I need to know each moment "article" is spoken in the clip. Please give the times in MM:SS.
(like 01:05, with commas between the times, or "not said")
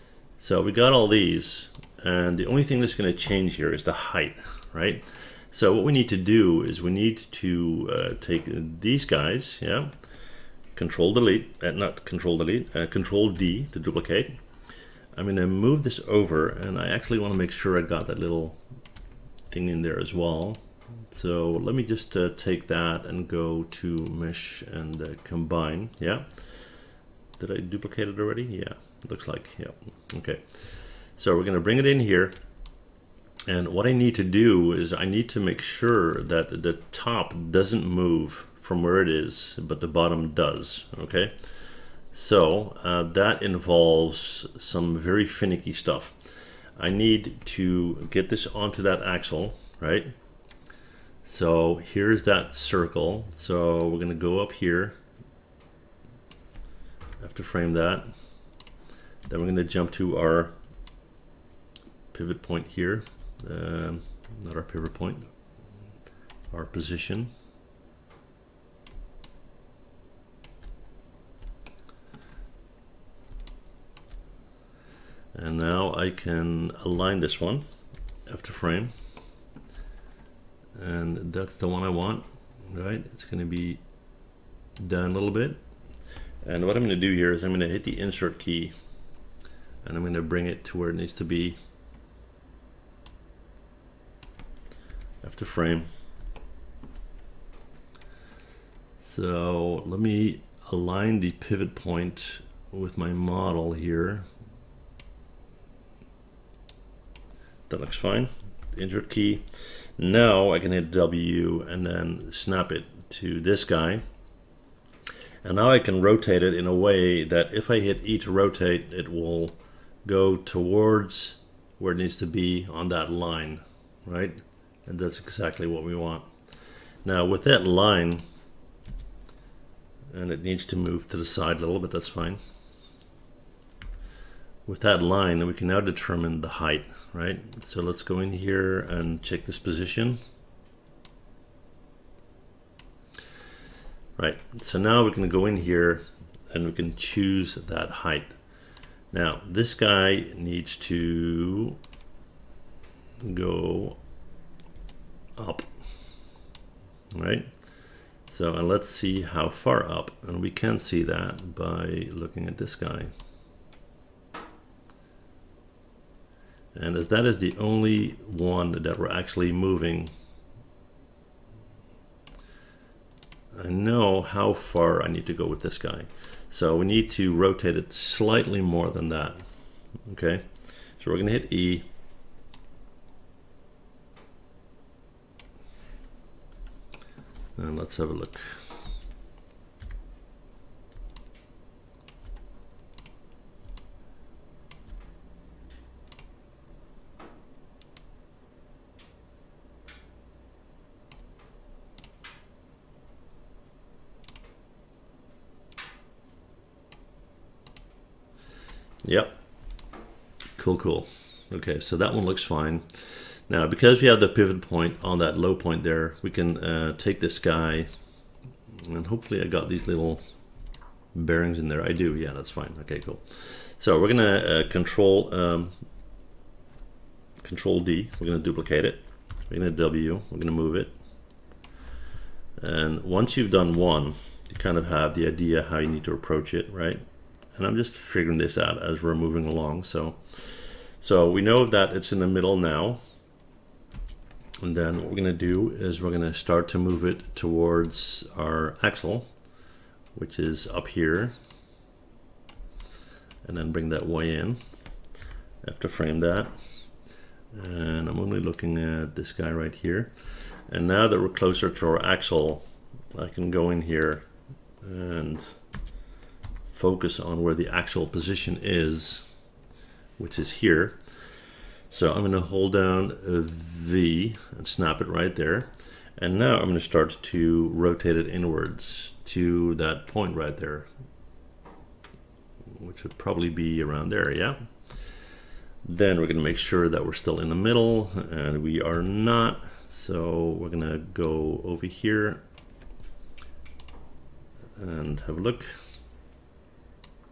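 not said.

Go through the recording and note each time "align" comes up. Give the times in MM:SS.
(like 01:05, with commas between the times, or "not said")
01:16, 01:40.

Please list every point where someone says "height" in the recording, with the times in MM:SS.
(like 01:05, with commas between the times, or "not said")
00:03, 02:16, 02:27.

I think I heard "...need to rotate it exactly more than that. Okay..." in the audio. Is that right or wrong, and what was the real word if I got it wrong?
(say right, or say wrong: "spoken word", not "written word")
wrong: "slightly", not "exactly".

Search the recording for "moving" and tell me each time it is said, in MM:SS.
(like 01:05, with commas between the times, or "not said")
02:49, 03:59.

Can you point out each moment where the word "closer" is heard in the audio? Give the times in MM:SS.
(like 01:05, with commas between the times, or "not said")
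04:21.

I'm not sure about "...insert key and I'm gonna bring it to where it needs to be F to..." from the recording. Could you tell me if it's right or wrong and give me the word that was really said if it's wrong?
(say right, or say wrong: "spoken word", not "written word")
right.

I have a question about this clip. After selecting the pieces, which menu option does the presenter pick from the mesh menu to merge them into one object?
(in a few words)
Combine.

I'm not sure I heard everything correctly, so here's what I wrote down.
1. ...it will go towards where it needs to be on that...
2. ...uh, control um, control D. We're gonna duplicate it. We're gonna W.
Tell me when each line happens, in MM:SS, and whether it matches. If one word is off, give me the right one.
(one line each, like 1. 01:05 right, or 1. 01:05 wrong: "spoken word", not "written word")
1. 01:58 right
2. 03:44 right.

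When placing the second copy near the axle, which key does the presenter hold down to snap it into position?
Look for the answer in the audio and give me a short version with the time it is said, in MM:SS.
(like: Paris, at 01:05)
V, at 04:33.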